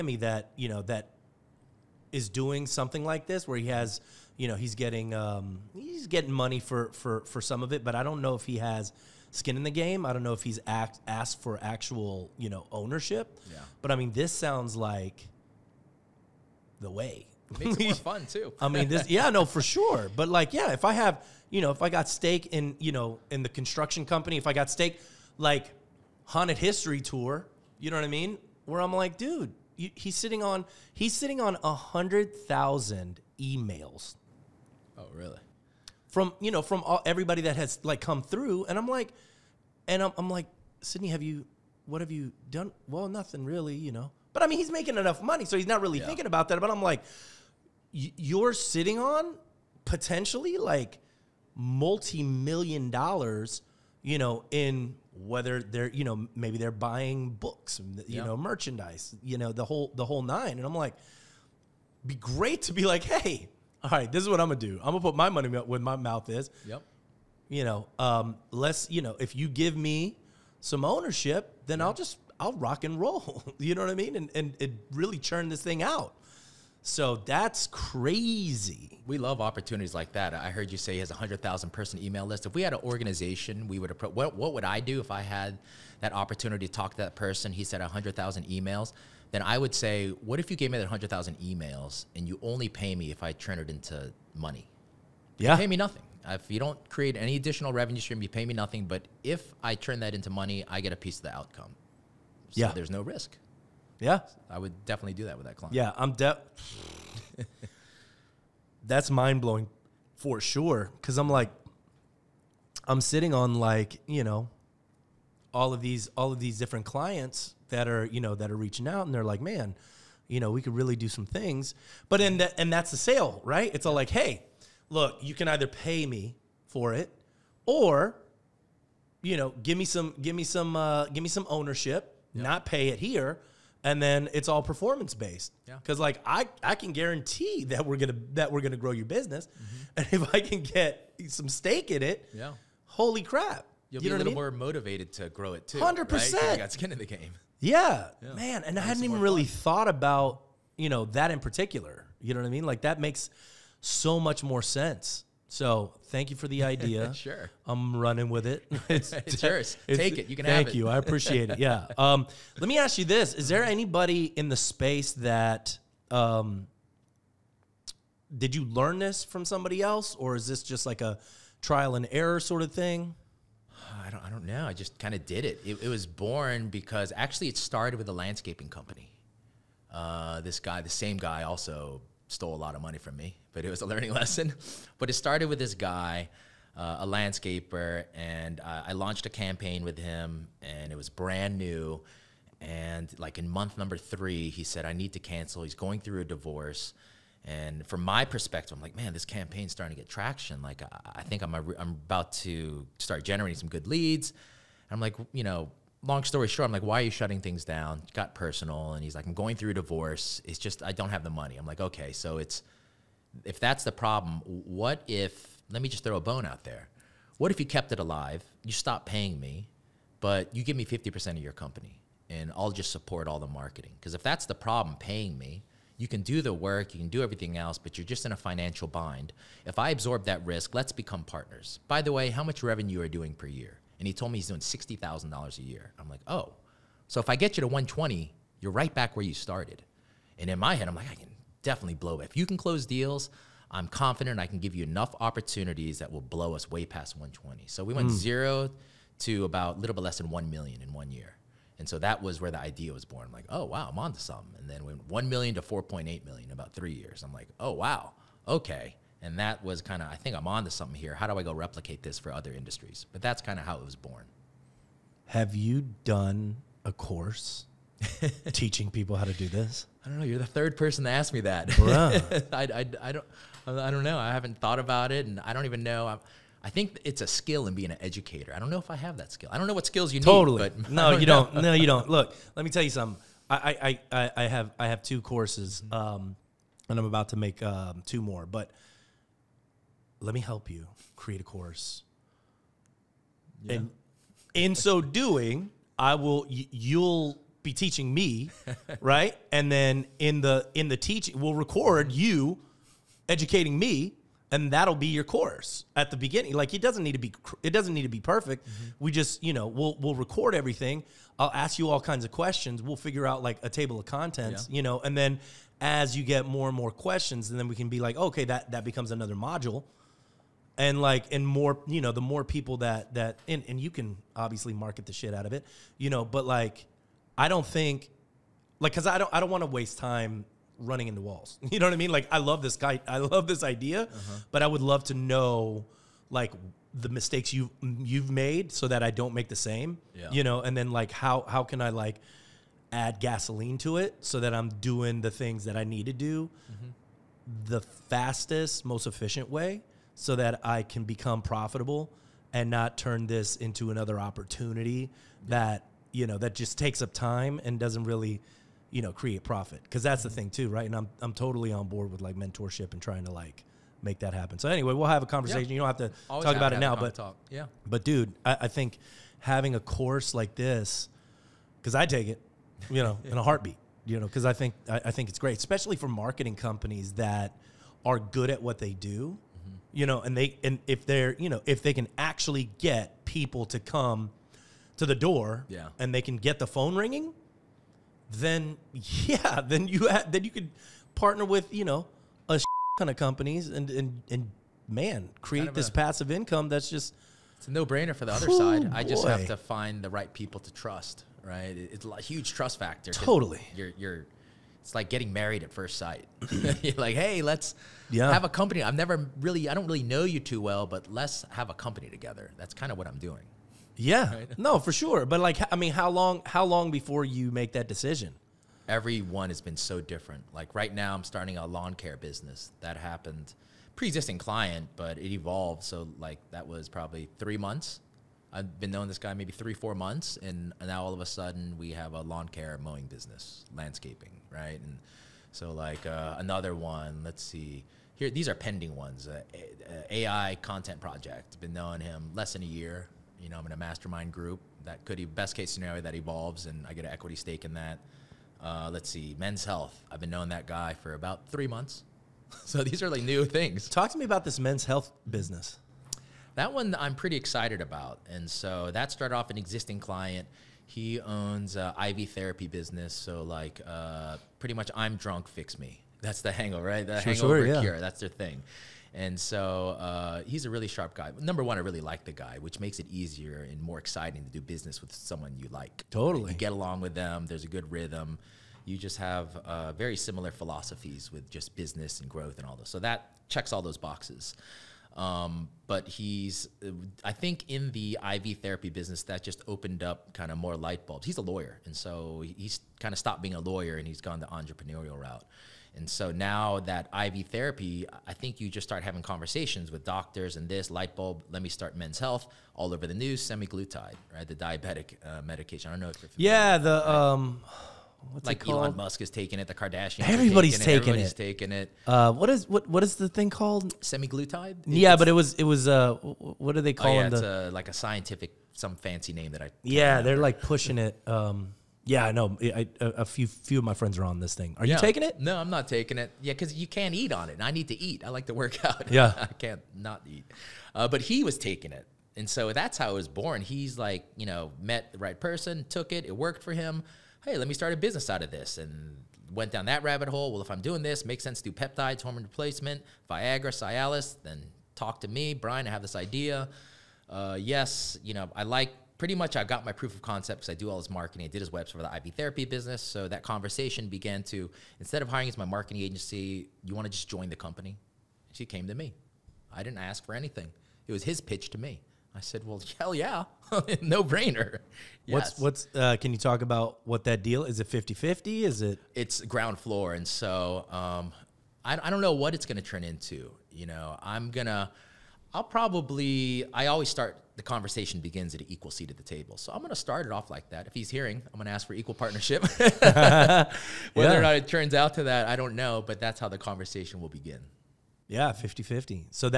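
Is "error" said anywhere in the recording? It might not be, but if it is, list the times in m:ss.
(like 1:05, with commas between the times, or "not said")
2:52.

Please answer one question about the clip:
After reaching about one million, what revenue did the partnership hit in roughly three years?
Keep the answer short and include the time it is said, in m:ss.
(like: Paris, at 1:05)
4.8 million, at 4:15.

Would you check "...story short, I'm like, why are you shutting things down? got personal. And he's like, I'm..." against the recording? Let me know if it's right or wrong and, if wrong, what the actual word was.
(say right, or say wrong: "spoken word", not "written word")
right.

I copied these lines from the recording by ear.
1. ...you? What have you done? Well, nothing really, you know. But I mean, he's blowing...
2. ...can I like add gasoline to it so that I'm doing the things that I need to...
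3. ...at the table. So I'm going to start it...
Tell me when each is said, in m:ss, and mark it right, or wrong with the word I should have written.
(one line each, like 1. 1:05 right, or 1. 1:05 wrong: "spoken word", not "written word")
1. 0:41 wrong: "making", not "blowing"
2. 5:41 right
3. 9:39 right.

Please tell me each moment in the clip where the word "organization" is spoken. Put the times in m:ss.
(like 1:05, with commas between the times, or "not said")
1:22.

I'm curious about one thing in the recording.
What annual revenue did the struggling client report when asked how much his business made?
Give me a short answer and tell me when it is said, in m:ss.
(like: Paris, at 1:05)
$60,000, at 3:54.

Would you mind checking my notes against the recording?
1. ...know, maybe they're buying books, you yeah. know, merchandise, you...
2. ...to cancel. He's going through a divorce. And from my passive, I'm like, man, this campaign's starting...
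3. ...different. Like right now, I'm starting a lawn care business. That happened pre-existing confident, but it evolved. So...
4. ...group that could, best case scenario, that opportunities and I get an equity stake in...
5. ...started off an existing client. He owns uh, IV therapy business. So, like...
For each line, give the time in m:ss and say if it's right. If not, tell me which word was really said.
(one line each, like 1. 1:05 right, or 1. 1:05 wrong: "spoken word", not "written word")
1. 0:56 right
2. 3:15 wrong: "perspective", not "passive"
3. 6:59 wrong: "client", not "confident"
4. 7:24 wrong: "evolves", not "opportunities"
5. 7:39 right.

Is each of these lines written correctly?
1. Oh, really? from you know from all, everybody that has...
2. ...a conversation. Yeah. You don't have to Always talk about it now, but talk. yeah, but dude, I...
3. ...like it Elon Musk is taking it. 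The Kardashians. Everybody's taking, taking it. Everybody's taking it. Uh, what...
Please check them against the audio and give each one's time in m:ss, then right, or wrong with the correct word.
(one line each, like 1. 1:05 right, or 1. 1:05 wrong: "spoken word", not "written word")
1. 0:34 right
2. 6:05 right
3. 8:28 right.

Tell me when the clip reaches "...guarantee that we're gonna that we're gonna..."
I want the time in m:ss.
2:16.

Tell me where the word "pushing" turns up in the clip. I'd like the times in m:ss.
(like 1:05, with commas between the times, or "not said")
8:40.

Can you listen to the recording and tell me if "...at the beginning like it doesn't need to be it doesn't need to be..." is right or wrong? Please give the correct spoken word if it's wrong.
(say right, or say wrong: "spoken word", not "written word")
right.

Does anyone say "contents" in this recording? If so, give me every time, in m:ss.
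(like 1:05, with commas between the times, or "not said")
5:14, 7:20.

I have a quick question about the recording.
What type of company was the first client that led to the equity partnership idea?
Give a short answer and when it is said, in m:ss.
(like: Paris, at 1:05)
landscaping company, at 2:58.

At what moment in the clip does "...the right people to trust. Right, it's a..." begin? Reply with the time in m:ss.
6:40.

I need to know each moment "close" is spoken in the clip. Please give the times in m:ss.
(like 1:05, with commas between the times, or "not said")
4:02.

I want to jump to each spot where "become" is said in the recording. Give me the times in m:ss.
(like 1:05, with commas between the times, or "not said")
3:50, 5:18, 5:51.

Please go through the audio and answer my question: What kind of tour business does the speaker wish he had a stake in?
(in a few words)
haunted history tour.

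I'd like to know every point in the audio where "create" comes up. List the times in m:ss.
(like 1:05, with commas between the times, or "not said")
1:36, 4:51, 5:59, 6:35.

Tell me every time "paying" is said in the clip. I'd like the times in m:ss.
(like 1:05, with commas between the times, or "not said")
3:39, 3:44.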